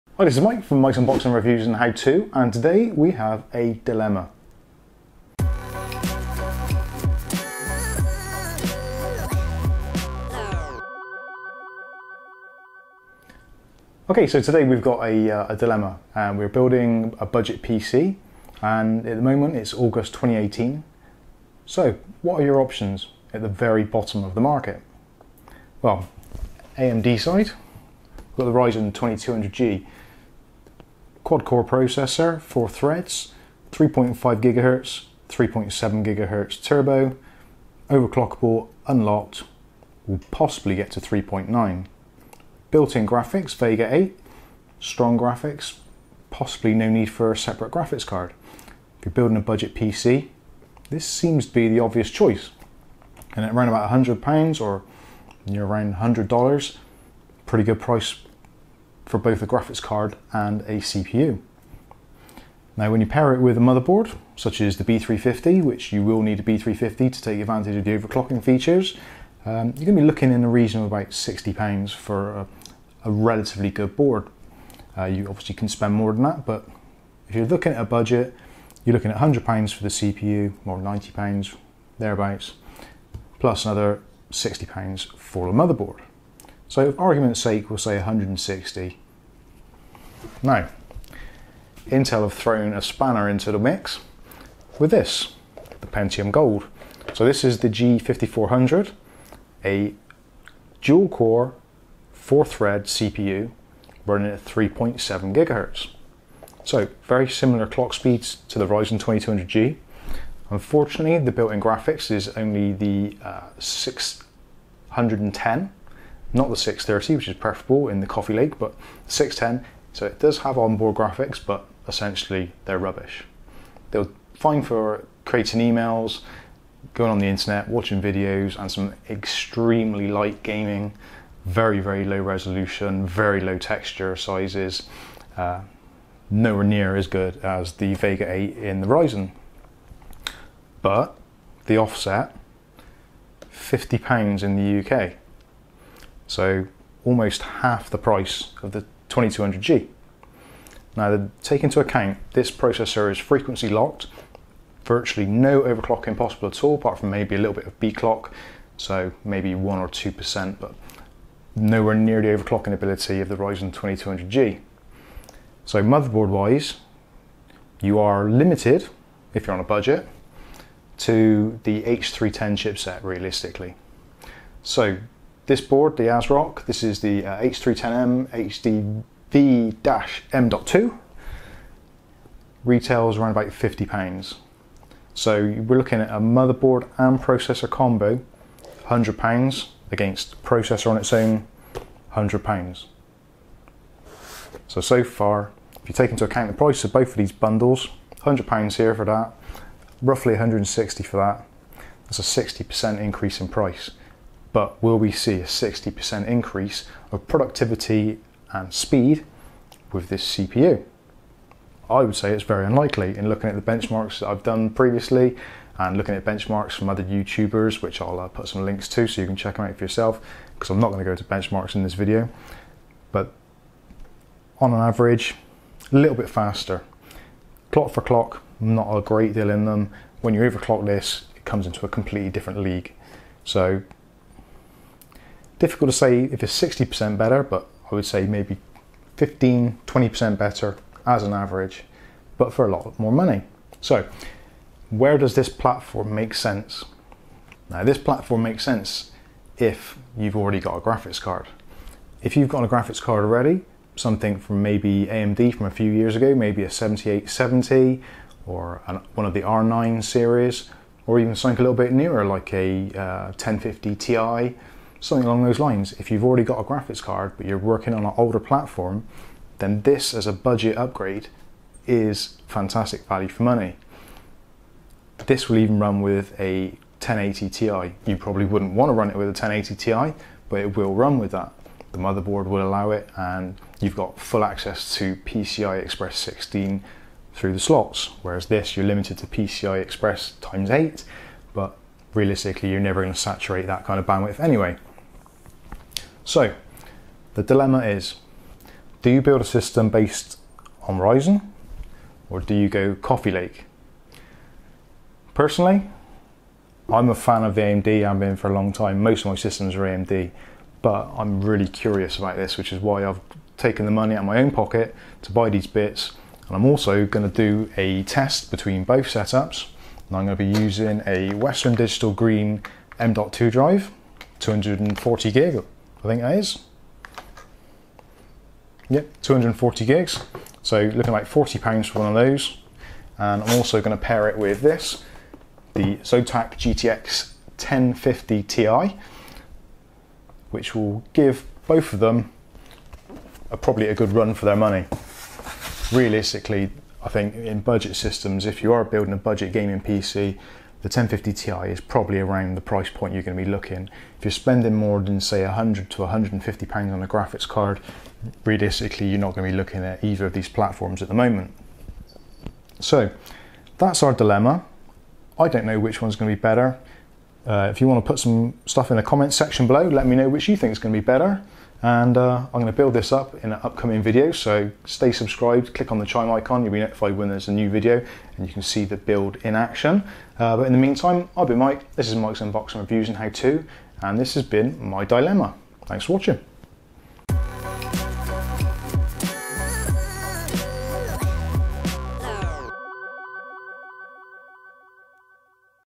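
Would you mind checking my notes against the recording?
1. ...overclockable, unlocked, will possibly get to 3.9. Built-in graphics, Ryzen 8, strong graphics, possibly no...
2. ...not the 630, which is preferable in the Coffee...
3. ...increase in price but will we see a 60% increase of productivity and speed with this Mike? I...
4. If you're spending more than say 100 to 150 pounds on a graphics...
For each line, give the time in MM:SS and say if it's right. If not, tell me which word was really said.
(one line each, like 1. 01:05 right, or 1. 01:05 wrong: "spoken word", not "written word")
1. 00:37 wrong: "Vega", not "Ryzen"
2. 01:56 right
3. 03:23 wrong: "CPU", not "Mike"
4. 05:54 right.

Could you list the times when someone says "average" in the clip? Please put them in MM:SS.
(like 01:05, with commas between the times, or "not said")
03:44, 04:01.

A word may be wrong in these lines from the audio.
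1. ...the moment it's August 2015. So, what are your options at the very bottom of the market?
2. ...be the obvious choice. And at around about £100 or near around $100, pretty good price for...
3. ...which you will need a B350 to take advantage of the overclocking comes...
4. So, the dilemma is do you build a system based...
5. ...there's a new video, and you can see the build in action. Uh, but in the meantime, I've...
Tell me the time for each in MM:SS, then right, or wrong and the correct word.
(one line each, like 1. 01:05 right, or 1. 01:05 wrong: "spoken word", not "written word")
1. 00:19 wrong: "2018", not "2015"
2. 00:51 right
3. 01:05 wrong: "features", not "comes"
4. 04:56 right
5. 06:17 right.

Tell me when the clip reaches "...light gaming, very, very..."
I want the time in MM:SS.
02:10.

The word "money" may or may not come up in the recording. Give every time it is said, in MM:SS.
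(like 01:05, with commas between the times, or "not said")
04:03, 04:33, 05:13, 05:44.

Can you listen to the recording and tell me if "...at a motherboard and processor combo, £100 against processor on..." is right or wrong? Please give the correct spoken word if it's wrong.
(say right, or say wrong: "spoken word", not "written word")
right.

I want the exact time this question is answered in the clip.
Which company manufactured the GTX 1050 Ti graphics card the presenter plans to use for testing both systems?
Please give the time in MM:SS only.
05:35.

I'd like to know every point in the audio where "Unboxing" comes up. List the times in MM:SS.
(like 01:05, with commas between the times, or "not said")
00:00, 06:22.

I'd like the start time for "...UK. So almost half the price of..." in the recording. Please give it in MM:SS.
02:24.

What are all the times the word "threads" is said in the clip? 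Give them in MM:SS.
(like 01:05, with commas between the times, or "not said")
00:32, 01:42.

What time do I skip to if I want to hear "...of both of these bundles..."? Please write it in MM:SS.
03:16.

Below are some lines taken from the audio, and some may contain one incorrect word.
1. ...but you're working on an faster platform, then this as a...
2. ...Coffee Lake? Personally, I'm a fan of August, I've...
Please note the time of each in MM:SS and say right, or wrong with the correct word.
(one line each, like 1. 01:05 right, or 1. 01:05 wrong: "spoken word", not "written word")
1. 04:27 wrong: "older", not "faster"
2. 05:02 wrong: "AMD", not "August".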